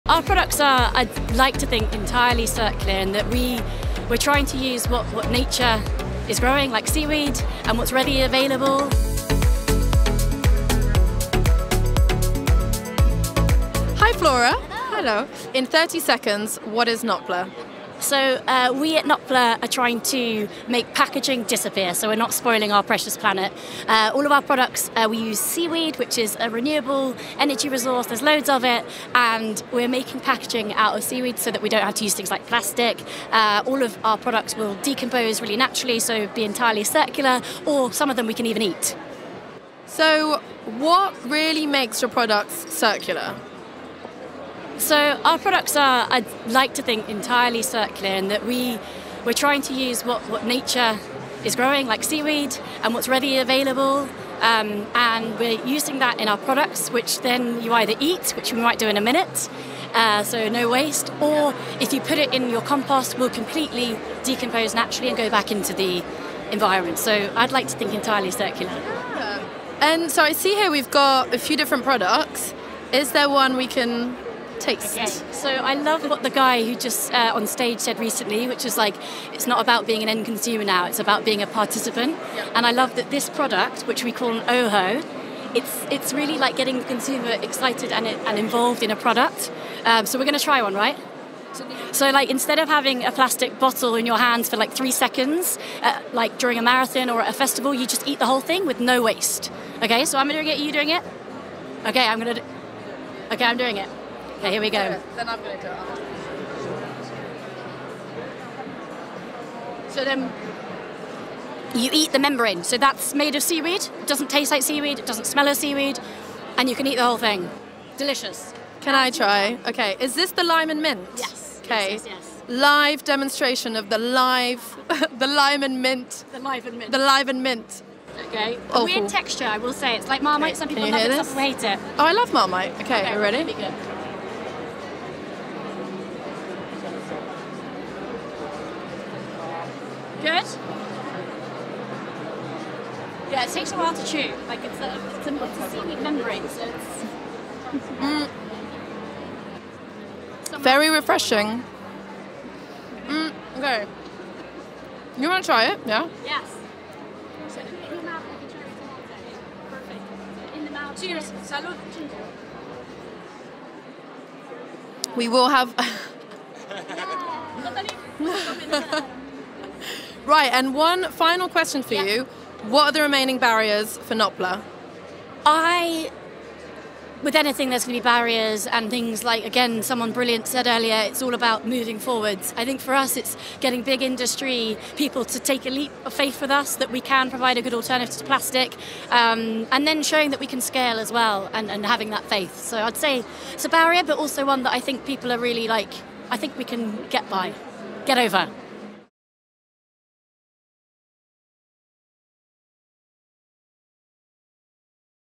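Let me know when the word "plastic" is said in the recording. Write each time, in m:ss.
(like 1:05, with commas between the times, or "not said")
0:32, 1:33, 3:08.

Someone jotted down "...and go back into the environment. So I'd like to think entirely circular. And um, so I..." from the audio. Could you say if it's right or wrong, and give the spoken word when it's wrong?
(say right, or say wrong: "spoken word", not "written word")
right.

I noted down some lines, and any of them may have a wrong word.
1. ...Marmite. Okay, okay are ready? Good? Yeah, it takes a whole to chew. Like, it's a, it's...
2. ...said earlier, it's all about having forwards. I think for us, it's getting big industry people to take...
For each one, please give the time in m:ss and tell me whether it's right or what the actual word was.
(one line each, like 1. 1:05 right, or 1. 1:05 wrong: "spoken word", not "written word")
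1. 2:12 wrong: "while", not "whole"
2. 3:00 wrong: "moving", not "having".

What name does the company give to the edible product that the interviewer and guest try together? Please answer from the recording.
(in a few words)
Ooho.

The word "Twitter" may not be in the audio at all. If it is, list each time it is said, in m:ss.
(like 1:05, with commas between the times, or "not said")
not said.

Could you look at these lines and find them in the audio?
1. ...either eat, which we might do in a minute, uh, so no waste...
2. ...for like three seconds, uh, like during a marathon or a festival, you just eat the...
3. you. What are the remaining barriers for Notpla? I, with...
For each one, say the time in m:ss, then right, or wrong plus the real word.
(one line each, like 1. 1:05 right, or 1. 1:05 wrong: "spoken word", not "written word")
1. 0:57 right
2. 1:34 right
3. 2:52 right.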